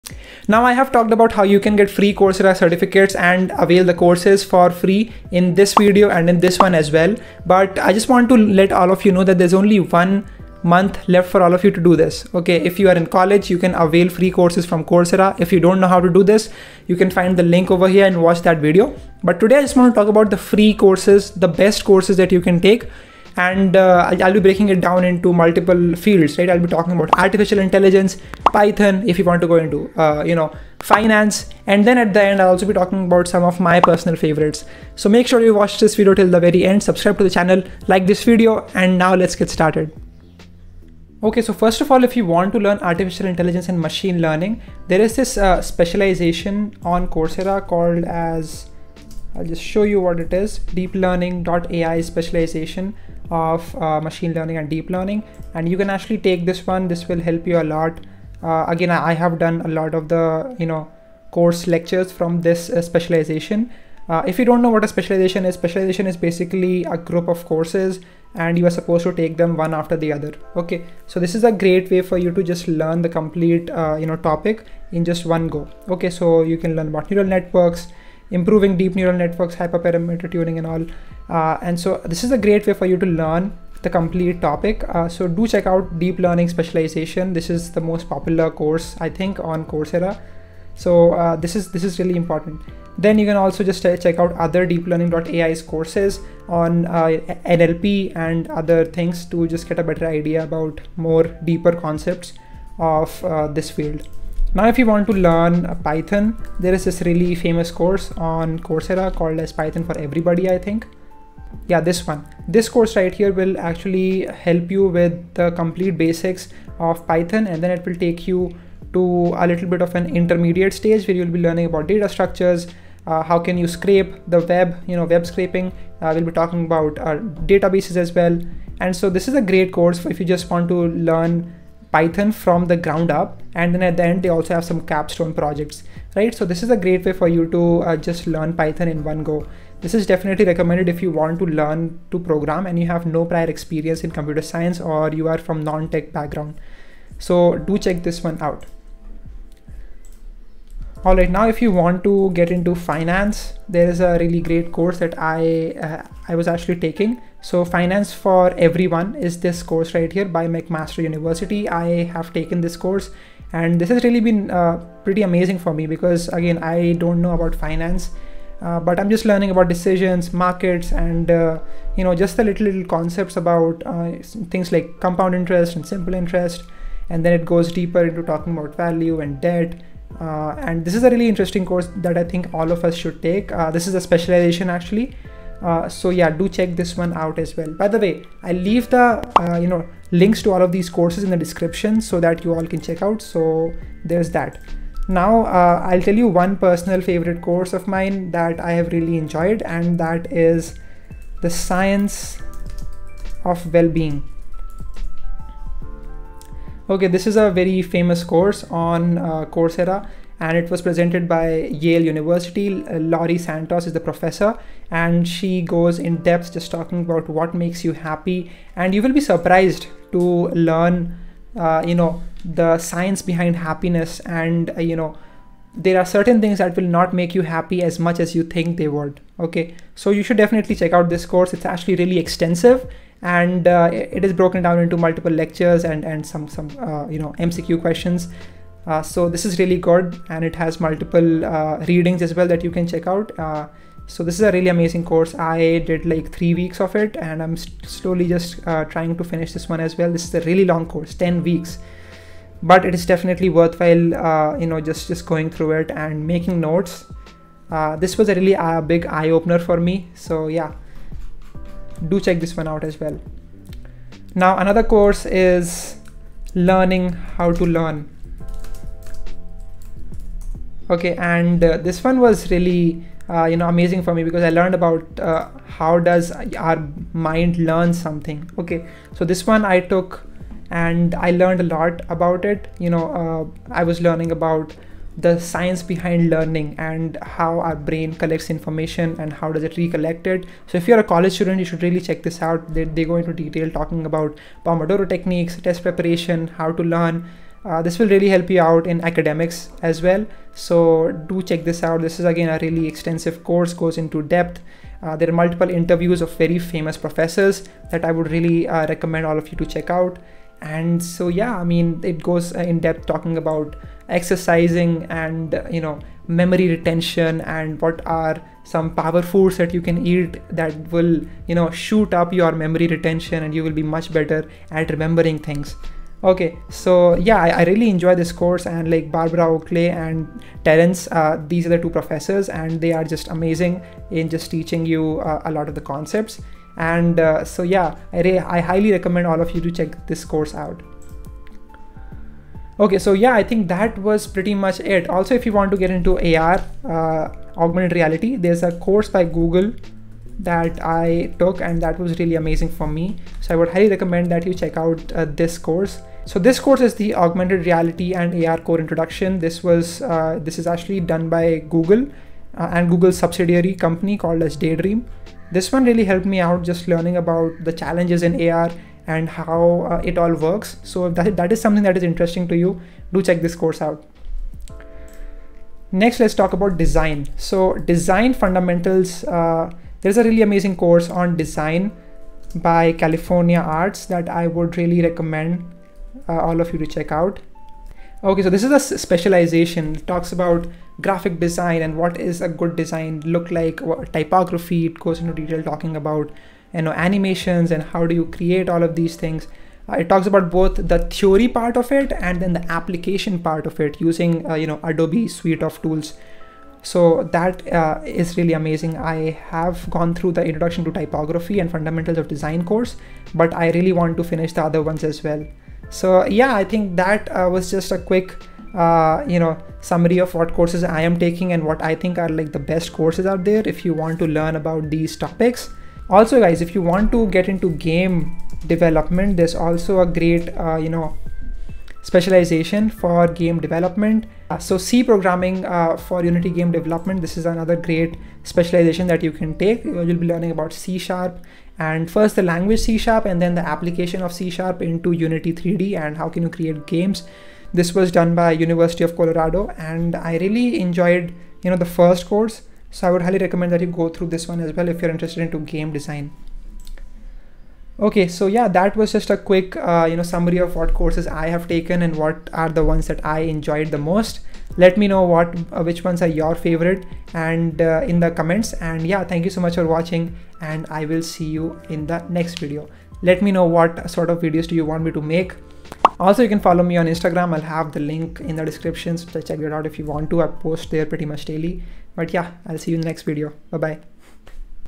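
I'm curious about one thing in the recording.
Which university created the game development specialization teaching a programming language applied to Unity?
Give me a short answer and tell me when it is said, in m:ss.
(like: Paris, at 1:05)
University of Colorado, at 7:28.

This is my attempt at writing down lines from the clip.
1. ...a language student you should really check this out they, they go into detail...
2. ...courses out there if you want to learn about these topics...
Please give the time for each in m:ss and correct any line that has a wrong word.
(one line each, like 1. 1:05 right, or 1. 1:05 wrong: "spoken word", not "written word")
1. 4:50 wrong: "college", not "language"
2. 7:02 right.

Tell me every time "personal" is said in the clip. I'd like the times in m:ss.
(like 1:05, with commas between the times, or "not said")
0:33, 3:16.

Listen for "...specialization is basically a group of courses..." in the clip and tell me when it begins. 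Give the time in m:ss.
1:05.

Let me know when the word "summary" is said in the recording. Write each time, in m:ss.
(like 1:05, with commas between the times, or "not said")
6:59, 7:40.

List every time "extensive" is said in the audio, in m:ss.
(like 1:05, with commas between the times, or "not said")
3:52, 5:02.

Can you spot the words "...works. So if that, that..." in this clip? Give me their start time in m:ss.
6:10.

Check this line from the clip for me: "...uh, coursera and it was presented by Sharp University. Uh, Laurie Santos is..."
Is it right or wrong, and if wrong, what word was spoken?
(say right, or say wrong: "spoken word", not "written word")
wrong: "Yale", not "Sharp".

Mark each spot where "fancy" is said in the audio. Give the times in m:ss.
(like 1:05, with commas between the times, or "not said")
not said.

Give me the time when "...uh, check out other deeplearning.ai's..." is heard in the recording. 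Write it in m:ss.
1:33.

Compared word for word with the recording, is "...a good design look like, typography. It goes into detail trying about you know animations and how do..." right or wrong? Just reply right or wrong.
wrong.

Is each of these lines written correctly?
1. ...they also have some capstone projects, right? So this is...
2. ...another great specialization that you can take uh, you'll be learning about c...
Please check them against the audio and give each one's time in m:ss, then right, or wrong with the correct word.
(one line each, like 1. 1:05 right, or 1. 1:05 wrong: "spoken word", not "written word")
1. 2:14 right
2. 7:17 right.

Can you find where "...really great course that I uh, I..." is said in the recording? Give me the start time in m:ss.
2:34.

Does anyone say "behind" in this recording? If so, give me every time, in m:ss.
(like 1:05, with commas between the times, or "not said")
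3:43, 4:45.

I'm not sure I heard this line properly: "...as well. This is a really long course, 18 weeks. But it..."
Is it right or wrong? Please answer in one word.
wrong.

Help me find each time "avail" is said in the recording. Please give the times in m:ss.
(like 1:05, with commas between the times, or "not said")
0:03, 0:13.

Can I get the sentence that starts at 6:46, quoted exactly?
So that uh, is really amazing.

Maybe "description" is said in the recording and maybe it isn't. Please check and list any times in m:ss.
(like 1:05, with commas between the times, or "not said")
3:11, 7:58.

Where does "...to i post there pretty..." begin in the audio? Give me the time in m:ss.
8:00.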